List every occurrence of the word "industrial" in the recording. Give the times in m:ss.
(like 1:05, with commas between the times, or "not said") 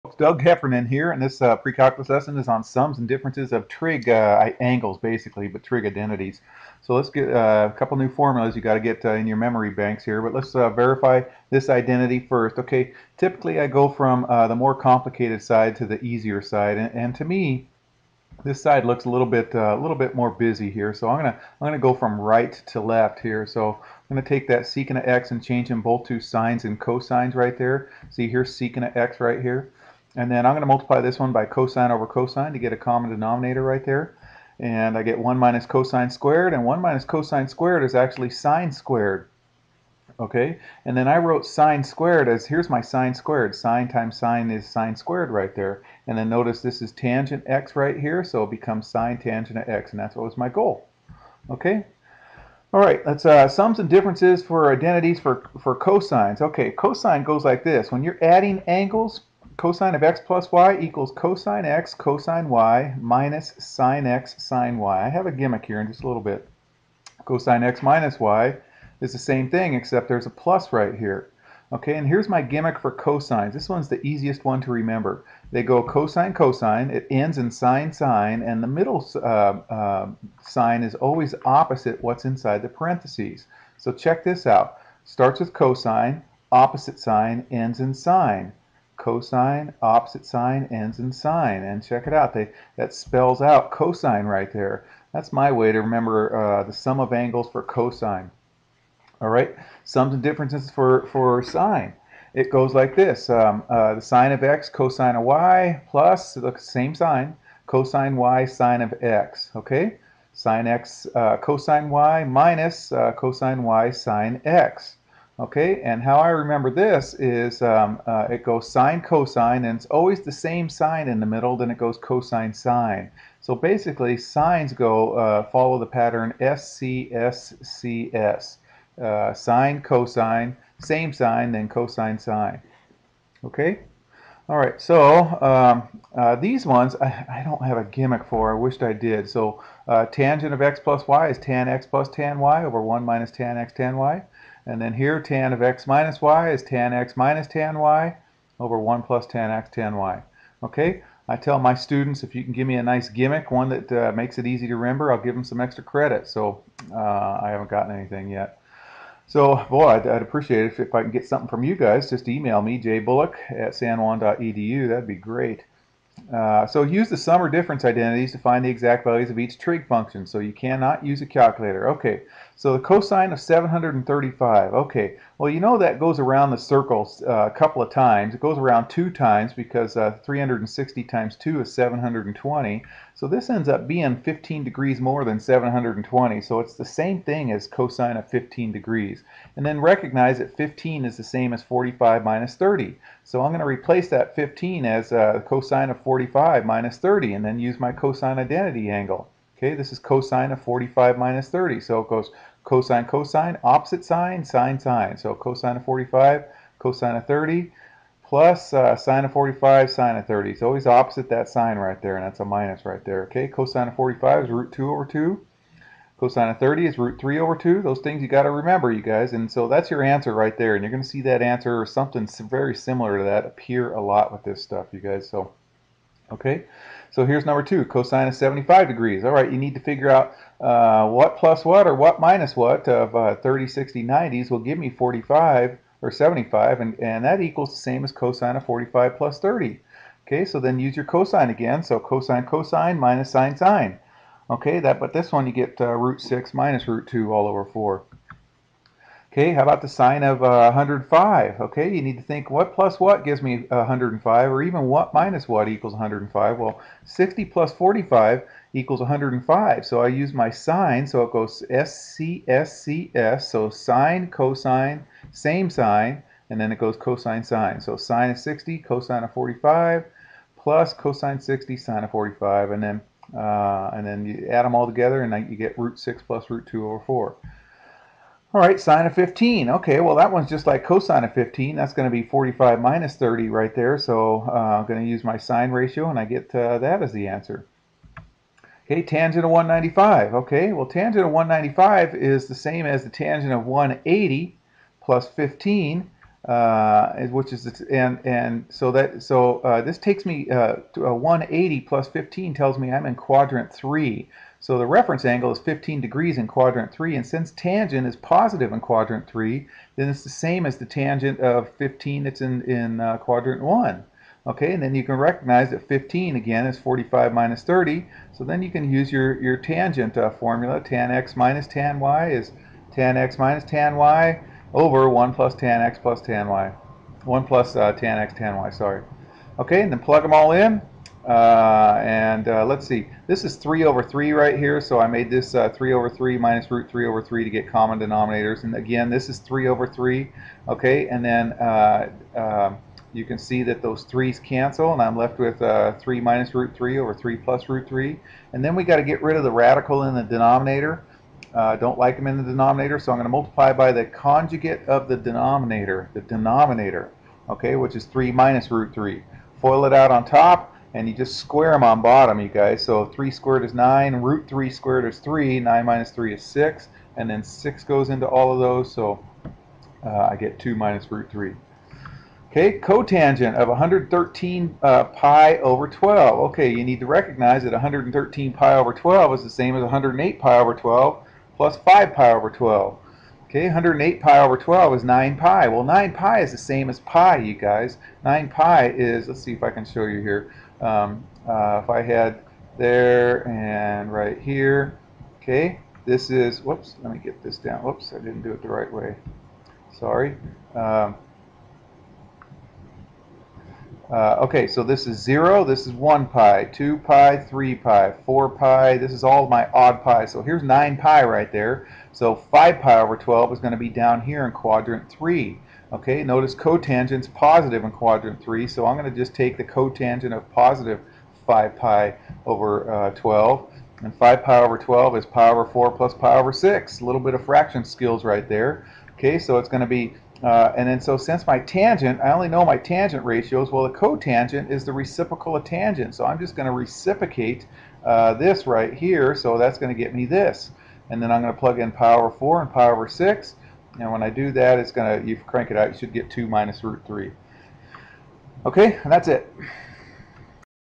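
not said.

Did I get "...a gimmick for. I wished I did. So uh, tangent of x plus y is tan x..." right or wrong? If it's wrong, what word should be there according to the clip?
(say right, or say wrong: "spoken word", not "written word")
right.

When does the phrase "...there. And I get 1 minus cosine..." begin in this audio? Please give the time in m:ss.
0:33.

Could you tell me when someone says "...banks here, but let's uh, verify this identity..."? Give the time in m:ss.
0:09.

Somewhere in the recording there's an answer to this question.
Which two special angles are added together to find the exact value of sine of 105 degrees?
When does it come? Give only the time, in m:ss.
4:17.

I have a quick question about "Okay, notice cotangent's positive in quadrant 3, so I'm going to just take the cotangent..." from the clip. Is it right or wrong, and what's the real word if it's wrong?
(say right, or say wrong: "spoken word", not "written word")
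right.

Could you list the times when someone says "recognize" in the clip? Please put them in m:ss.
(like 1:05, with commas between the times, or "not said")
3:09, 5:15, 6:17.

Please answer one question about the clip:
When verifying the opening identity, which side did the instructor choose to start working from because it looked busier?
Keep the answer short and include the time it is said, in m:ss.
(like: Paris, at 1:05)
right to left, at 0:22.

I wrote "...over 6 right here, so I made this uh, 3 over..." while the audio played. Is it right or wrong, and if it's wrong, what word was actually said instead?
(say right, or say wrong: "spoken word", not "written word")
wrong: "3", not "6".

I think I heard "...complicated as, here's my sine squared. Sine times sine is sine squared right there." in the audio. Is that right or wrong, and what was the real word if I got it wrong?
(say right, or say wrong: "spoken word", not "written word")
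wrong: "squared", not "complicated".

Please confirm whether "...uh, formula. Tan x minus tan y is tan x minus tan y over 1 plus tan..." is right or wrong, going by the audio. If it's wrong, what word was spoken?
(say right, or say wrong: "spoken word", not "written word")
right.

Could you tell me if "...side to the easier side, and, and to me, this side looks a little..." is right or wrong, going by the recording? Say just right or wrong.
right.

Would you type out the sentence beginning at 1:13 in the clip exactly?
This one's the easiest one to remember.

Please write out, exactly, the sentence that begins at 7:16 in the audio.
So I'm just going to reciprocate uh, this right here, so that's going to get me this.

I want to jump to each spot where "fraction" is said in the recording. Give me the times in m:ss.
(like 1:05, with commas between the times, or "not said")
7:07.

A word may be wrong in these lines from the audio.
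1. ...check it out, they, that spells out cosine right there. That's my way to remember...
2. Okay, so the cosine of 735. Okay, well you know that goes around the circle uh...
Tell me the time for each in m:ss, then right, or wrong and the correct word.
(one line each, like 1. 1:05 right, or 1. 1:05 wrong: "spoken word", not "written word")
1. 1:31 right
2. 2:51 right.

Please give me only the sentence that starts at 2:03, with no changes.
So basically, signs go uh, follow the pattern SCSCS.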